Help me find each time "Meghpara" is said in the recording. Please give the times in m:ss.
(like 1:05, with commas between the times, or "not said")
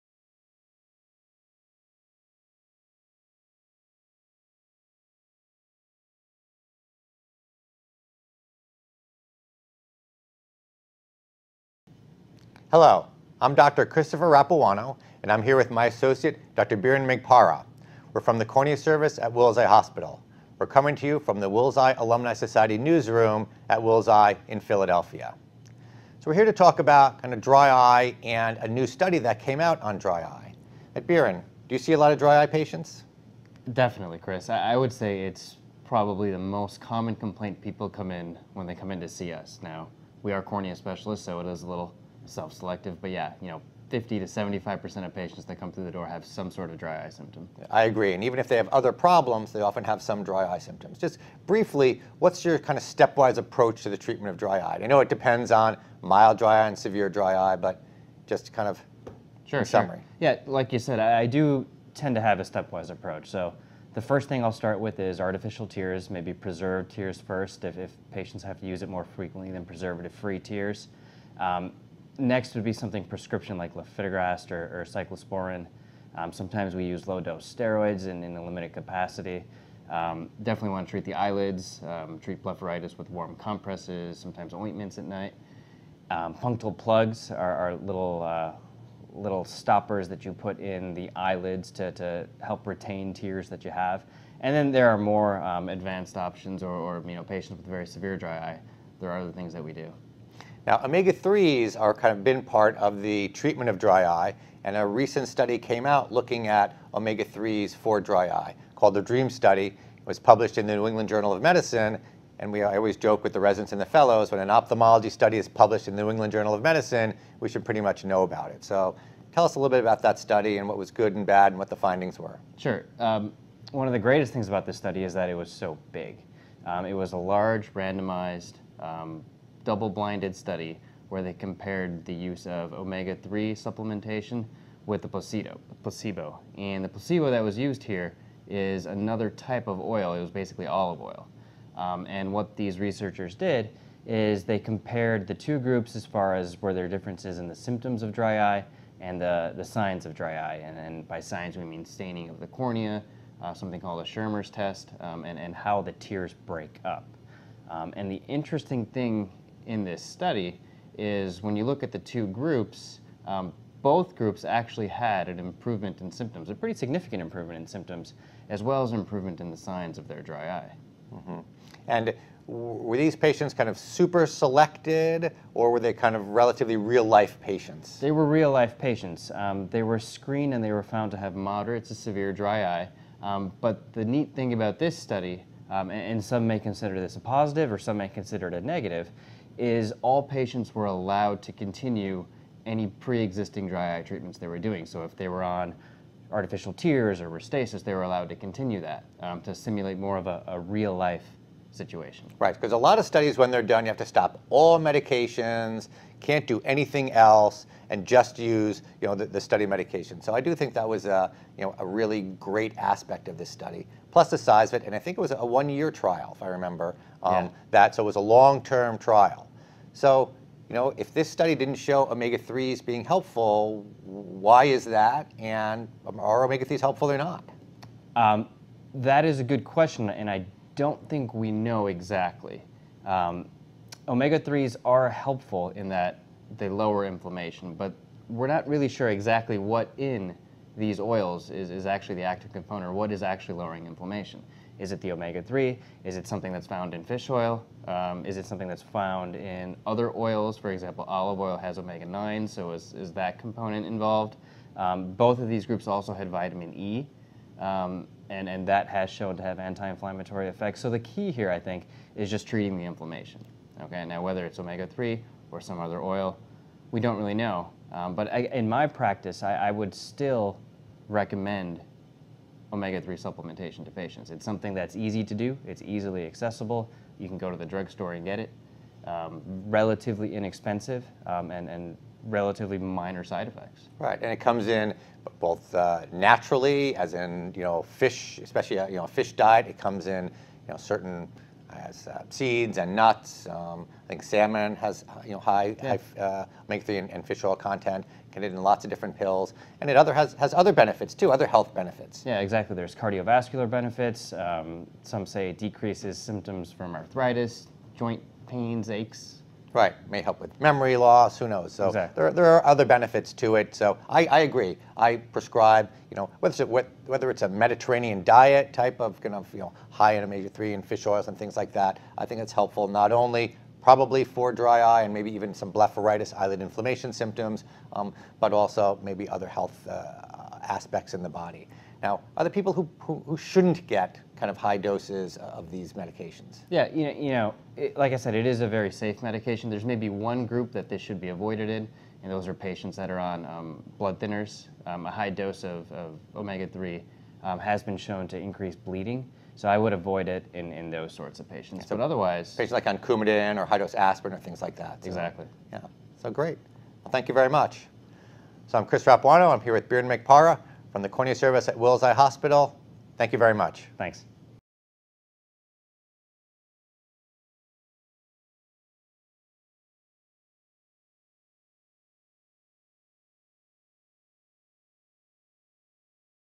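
0:17, 6:00.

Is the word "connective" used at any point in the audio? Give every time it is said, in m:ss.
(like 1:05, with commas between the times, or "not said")
not said.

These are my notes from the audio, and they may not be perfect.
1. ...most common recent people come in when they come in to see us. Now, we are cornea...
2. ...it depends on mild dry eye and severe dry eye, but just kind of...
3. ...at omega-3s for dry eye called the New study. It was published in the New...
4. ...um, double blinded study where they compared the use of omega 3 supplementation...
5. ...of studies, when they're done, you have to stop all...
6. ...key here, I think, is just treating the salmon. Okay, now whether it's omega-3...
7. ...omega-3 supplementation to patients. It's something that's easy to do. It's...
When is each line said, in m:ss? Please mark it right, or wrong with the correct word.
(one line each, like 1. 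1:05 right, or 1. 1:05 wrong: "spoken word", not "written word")
1. 0:36 wrong: "complaint", not "recent"
2. 0:55 right
3. 1:46 wrong: "DREAM", not "New"
4. 2:08 right
5. 3:22 right
6. 4:20 wrong: "inflammation", not "salmon"
7. 4:32 right.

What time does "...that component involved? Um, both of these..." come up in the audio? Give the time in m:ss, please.
4:13.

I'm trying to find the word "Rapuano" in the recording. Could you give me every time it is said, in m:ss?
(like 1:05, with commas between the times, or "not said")
0:14, 5:59.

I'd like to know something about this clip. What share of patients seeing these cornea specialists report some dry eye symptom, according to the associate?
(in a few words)
50 to 75%.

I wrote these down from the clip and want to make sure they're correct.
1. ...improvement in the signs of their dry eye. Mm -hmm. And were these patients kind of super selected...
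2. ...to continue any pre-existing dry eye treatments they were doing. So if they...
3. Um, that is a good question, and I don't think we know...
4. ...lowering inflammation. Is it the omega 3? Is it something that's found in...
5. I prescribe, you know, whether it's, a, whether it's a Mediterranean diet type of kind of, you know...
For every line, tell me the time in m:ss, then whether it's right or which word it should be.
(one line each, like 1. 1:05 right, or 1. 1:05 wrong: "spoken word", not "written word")
1. 2:48 right
2. 3:11 right
3. 3:48 right
4. 4:03 right
5. 5:14 right.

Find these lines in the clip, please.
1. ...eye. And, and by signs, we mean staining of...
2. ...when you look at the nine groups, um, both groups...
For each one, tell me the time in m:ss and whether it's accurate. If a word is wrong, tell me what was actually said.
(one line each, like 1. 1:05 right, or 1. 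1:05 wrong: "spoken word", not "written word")
1. 2:30 right
2. 2:41 wrong: "two", not "nine".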